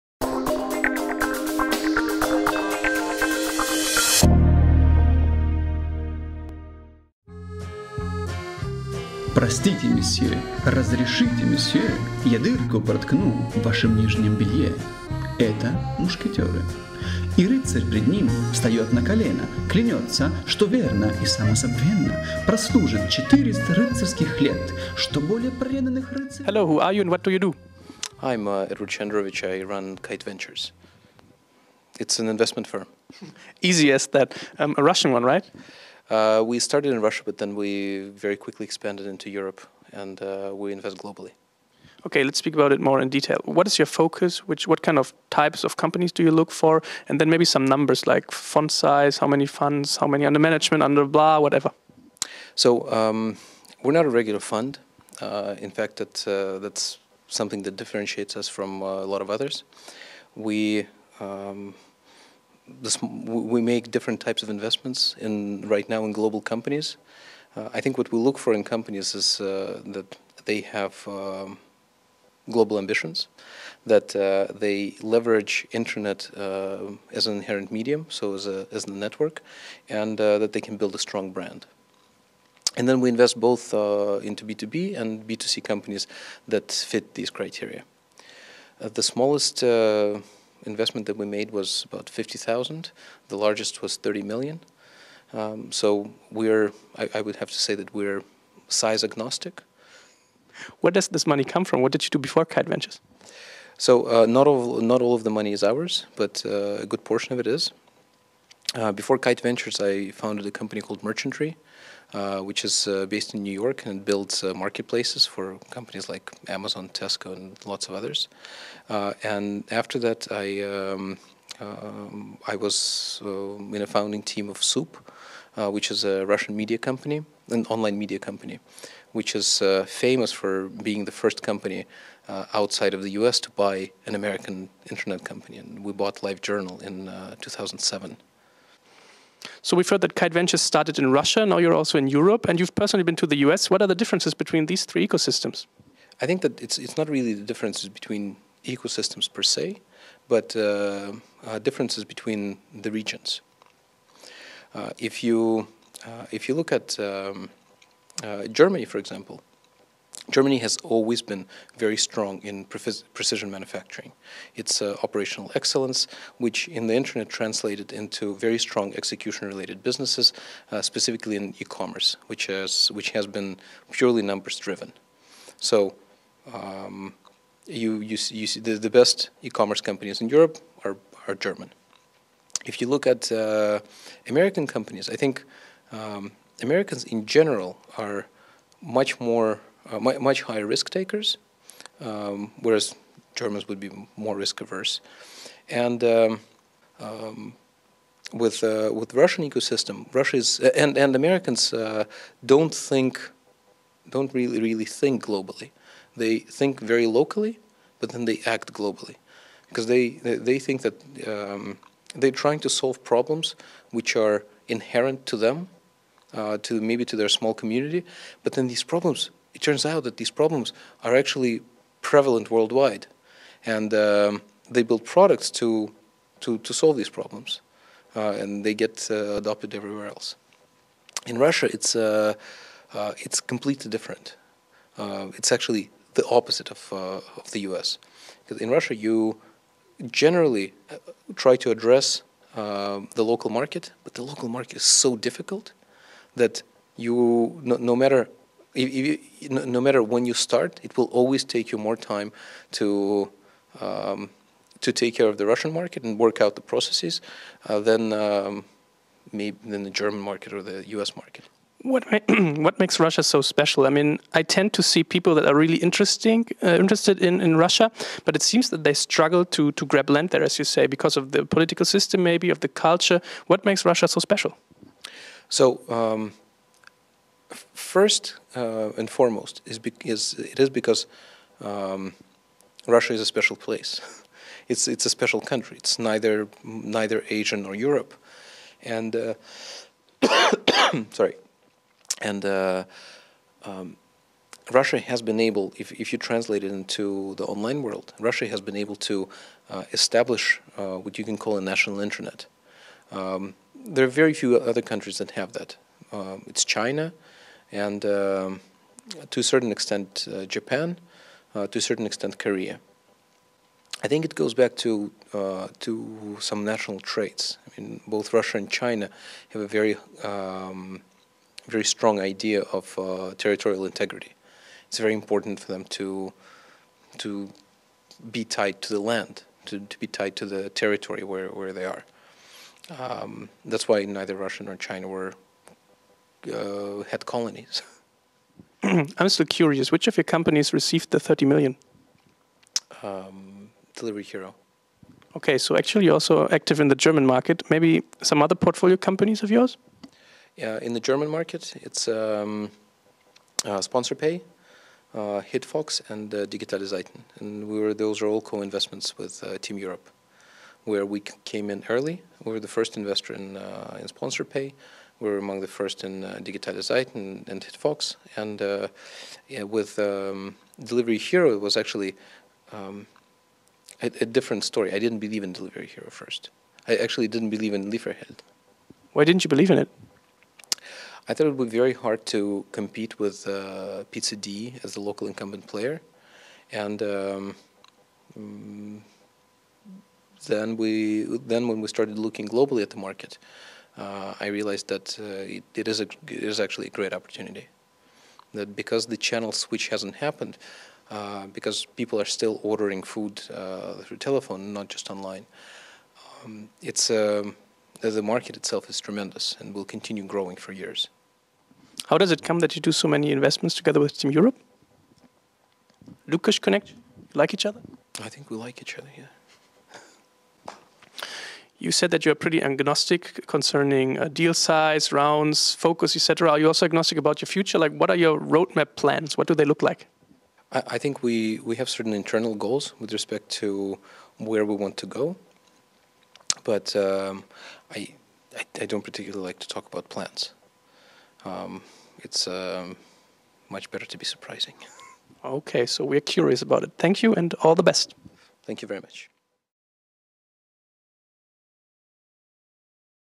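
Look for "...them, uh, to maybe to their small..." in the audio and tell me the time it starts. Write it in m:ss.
3:35.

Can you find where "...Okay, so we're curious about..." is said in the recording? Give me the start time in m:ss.
7:25.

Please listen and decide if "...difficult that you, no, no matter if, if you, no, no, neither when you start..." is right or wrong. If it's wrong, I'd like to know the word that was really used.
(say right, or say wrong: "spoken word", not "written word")
wrong: "matter", not "neither".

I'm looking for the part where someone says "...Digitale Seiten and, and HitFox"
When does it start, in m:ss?
6:06.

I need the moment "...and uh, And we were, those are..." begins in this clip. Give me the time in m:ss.
5:56.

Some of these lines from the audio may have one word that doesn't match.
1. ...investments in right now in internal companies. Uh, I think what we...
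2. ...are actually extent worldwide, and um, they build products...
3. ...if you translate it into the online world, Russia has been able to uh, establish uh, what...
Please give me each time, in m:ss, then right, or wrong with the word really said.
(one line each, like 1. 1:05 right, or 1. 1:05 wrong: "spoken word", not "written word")
1. 1:04 wrong: "global", not "internal"
2. 3:41 wrong: "prevalent", not "extent"
3. 4:55 right.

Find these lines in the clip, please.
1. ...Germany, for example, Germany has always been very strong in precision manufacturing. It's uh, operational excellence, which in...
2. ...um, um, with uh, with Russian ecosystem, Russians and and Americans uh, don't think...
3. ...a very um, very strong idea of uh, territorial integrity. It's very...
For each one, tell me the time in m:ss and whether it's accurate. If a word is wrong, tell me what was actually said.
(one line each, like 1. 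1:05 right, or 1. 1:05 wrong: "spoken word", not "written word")
1. 2:38 right
2. 3:16 right
3. 5:19 right.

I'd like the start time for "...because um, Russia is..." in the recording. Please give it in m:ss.
4:40.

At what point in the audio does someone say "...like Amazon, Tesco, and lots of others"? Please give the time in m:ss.
1:56.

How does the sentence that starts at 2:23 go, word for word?
What are the differences between these three ecosystems?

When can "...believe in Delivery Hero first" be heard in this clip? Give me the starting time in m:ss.
6:15.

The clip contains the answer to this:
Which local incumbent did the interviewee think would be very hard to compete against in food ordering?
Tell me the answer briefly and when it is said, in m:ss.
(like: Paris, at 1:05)
Pizza D, at 6:24.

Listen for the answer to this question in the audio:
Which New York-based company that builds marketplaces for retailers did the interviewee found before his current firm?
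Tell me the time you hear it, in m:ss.
1:51.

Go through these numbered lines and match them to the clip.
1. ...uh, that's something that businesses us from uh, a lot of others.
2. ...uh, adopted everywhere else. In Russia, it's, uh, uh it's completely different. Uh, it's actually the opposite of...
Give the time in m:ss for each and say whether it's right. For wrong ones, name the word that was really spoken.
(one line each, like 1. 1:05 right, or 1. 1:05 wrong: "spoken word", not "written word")
1. 0:56 wrong: "differentiates", not "businesses"
2. 3:49 right.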